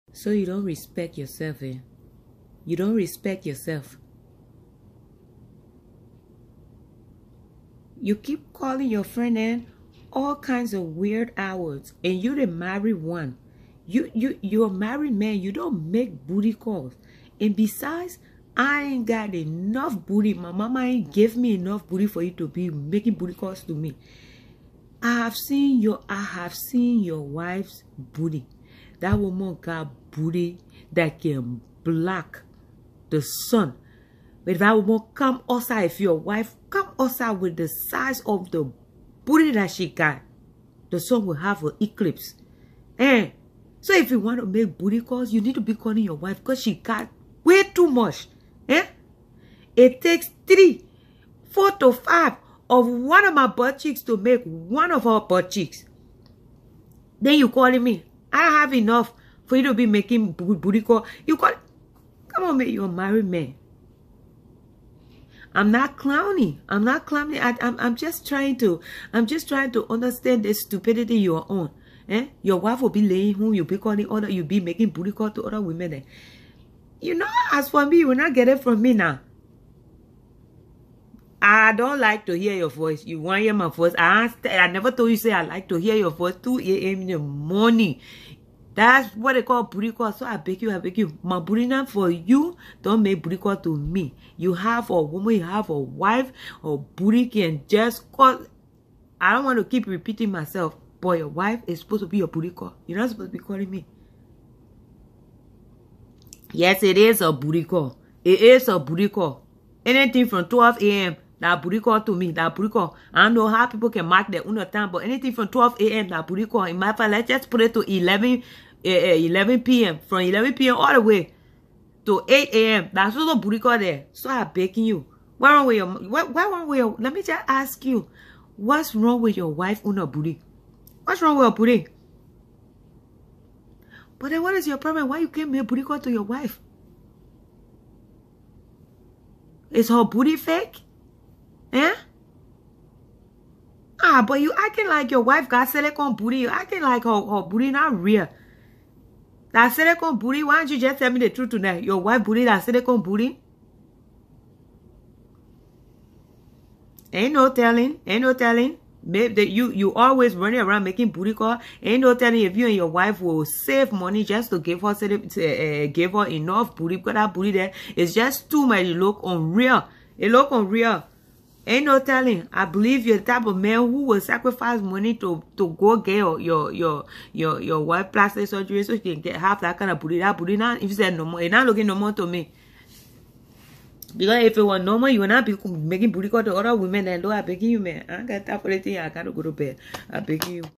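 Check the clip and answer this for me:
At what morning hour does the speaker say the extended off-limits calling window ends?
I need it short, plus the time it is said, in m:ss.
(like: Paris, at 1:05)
8 a.m., at 2:02.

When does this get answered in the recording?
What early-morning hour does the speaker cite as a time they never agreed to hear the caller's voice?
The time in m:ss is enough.
1:26.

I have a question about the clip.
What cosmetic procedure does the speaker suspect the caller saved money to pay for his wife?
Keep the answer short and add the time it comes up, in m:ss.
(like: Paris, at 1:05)
plastic surgery, at 2:58.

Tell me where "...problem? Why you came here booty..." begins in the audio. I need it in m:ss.
2:14.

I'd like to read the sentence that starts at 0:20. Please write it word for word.
My mama ain't gave me enough booty for you to be making booty calls to me.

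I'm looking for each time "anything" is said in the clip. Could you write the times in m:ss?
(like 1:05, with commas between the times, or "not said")
1:49, 1:55.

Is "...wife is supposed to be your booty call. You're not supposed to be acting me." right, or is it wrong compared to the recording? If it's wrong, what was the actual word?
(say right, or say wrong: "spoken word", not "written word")
wrong: "calling", not "acting".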